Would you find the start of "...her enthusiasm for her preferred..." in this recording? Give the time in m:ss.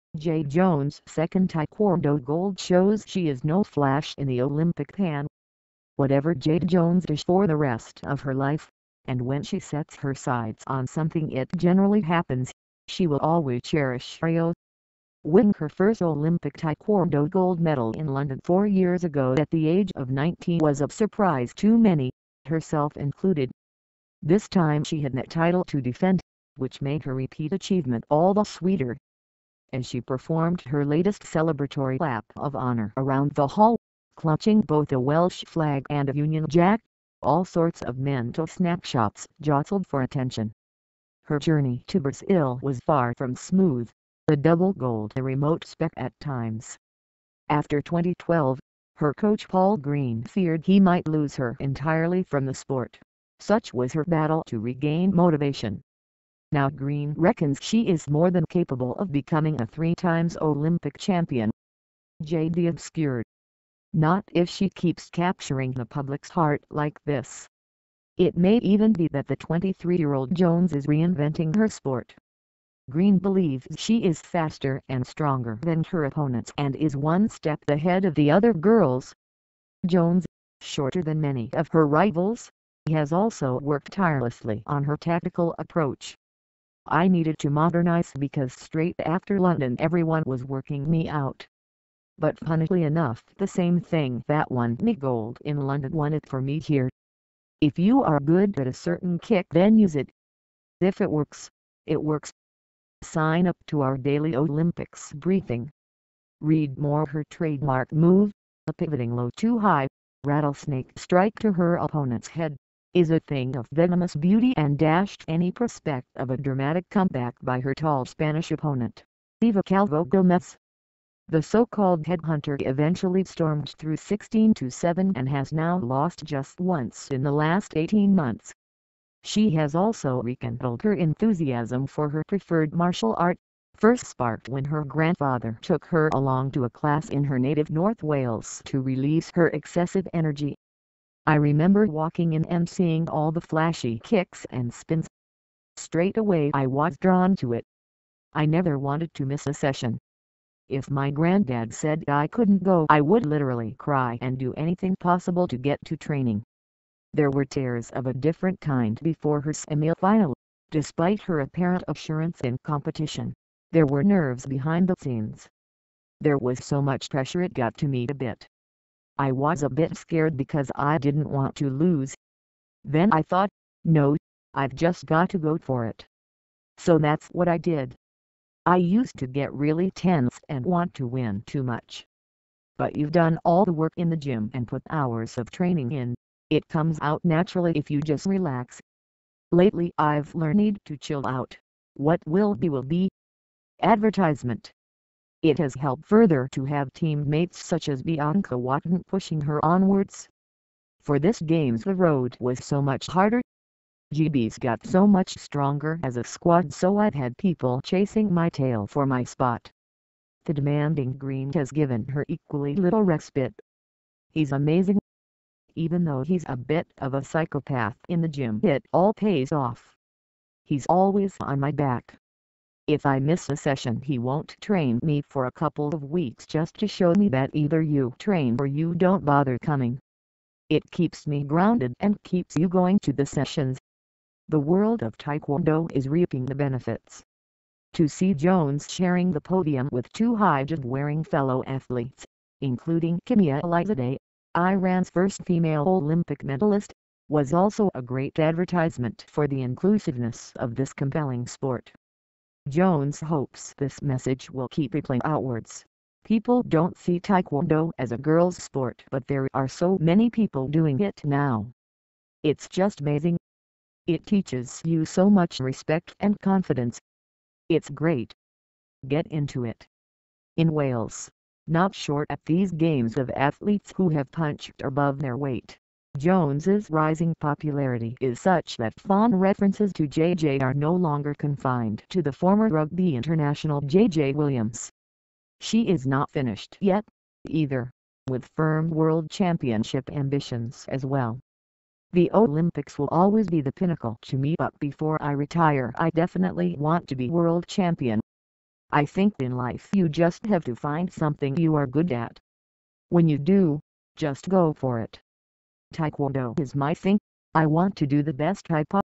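2:10.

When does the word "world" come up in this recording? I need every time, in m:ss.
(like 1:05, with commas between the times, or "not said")
3:54, 4:48, 4:57.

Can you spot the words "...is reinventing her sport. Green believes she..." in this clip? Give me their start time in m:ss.
1:10.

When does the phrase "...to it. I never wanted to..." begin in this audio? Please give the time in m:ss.
2:27.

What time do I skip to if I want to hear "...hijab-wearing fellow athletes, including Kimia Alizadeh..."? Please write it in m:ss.
4:00.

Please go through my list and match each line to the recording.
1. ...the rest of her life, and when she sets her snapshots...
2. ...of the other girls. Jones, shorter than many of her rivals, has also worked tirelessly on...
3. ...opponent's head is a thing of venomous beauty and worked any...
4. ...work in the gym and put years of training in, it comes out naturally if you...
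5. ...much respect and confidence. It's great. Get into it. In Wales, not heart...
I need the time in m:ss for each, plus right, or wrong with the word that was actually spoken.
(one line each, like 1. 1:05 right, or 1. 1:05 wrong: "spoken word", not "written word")
1. 0:07 wrong: "sights", not "snapshots"
2. 1:18 right
3. 1:51 wrong: "dashed", not "worked"
4. 3:03 wrong: "hours", not "years"
5. 4:25 wrong: "short", not "heart".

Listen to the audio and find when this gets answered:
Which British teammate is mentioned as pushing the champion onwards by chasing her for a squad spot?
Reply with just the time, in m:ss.
3:18.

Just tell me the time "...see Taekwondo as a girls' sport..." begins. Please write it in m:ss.
4:16.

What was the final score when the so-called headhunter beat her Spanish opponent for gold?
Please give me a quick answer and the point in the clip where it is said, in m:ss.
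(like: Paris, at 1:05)
16 to 7, at 2:03.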